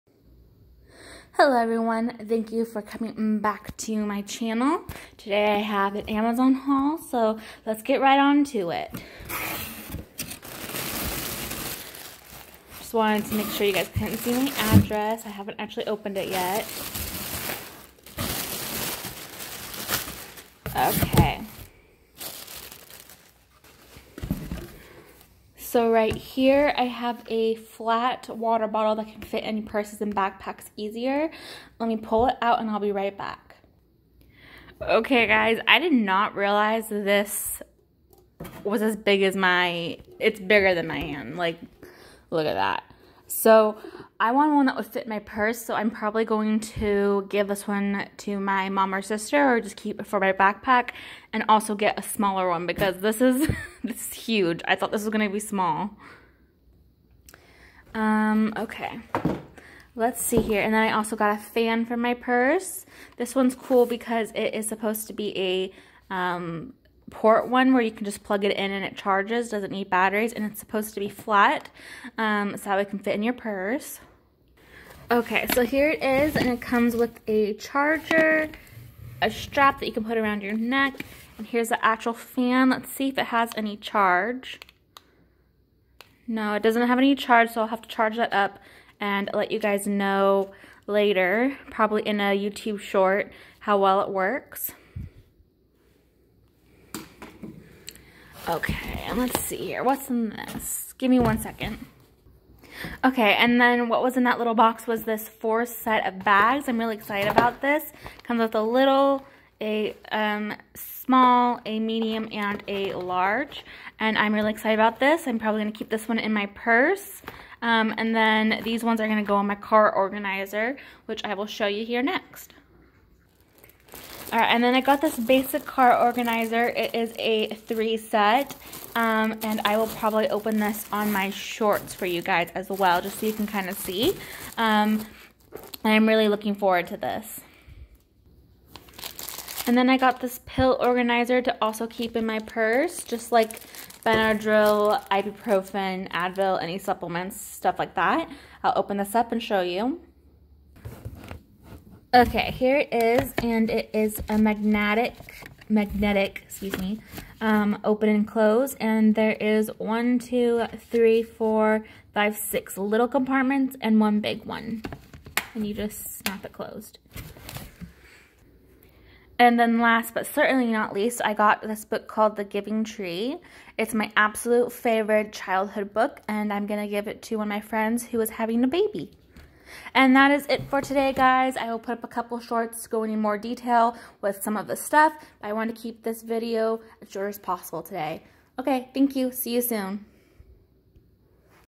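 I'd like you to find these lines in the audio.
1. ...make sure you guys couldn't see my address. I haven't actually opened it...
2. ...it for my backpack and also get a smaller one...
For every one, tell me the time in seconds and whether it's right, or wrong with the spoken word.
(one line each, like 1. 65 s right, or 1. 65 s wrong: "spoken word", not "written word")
1. 13 s right
2. 49 s right.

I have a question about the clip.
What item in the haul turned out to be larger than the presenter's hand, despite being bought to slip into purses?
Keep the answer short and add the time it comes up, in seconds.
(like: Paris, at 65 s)
flat water bottle, at 27 s.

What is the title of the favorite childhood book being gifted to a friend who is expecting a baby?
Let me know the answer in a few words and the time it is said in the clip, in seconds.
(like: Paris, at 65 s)
The Giving Tree, at 172 s.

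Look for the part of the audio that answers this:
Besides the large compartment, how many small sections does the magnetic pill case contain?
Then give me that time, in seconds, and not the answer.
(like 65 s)
162 s.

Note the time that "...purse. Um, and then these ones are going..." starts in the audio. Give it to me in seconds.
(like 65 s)
116 s.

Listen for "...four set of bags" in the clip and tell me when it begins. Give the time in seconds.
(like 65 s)
105 s.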